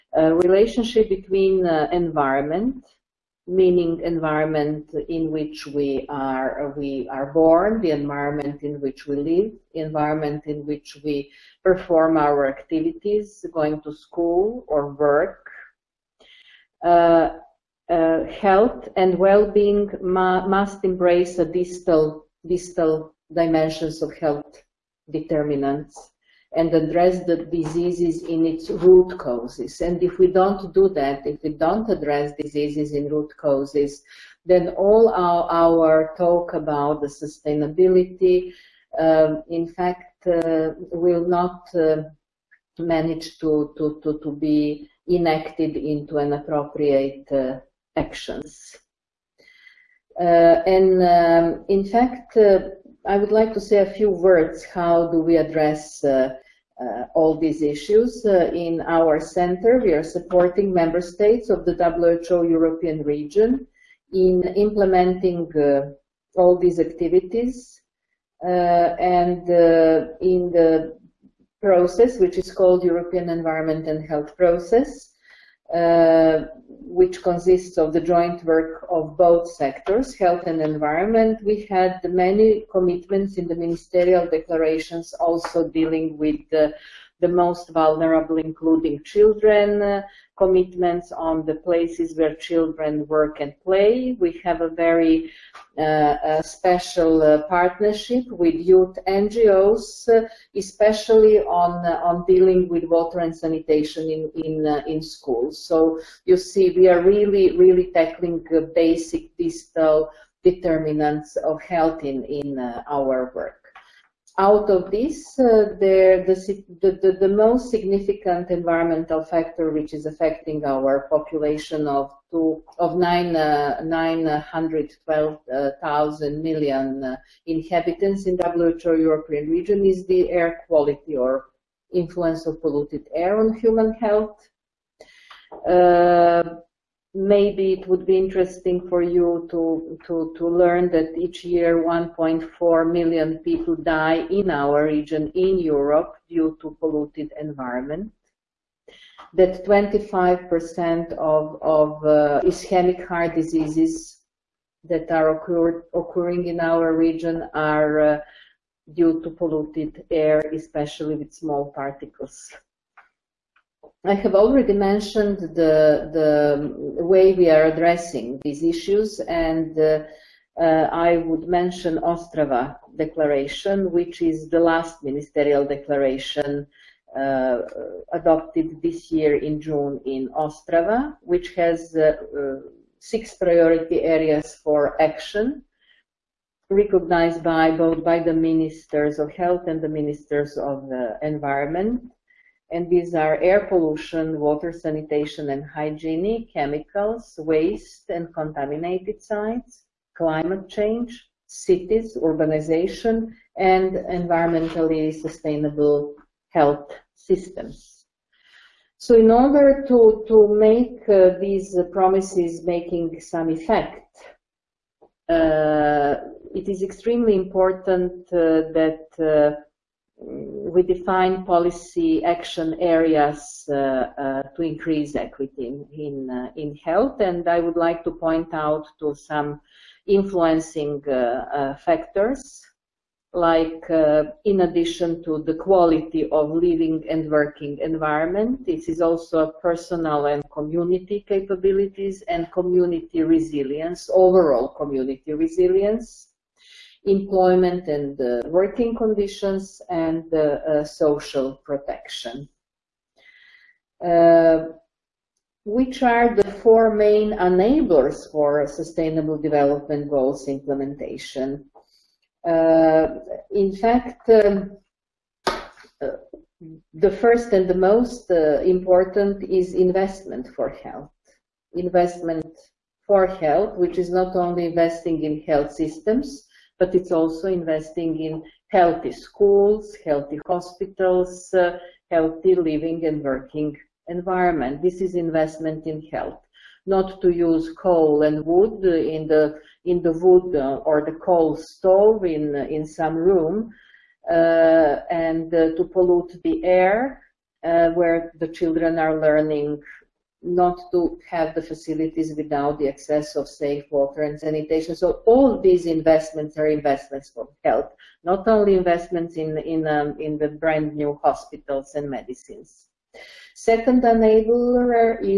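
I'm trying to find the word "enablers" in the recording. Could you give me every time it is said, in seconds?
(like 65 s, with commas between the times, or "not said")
257 s, 314 s.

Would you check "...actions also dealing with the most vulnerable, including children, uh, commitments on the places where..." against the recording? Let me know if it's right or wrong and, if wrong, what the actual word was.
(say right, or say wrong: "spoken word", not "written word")
wrong: "declarations", not "actions".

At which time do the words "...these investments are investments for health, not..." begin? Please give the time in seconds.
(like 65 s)
305 s.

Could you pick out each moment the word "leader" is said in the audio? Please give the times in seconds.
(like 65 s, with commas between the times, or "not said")
not said.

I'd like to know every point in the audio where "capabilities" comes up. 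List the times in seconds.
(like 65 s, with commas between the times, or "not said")
241 s.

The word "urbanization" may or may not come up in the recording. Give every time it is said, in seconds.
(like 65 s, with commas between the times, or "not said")
202 s.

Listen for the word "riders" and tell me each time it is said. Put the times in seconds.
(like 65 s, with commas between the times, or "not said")
not said.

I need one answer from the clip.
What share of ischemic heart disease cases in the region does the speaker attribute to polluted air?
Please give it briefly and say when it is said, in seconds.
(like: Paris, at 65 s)
25%, at 149 s.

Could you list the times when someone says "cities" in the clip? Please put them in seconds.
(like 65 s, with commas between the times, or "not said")
201 s.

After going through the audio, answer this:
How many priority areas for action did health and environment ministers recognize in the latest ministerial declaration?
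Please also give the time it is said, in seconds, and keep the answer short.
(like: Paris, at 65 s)
6, at 182 s.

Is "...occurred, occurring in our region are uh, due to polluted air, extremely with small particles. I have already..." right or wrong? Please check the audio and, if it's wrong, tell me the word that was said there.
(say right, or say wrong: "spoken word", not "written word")
wrong: "especially", not "extremely".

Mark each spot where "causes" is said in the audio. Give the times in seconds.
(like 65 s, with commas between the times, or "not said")
29 s, 33 s.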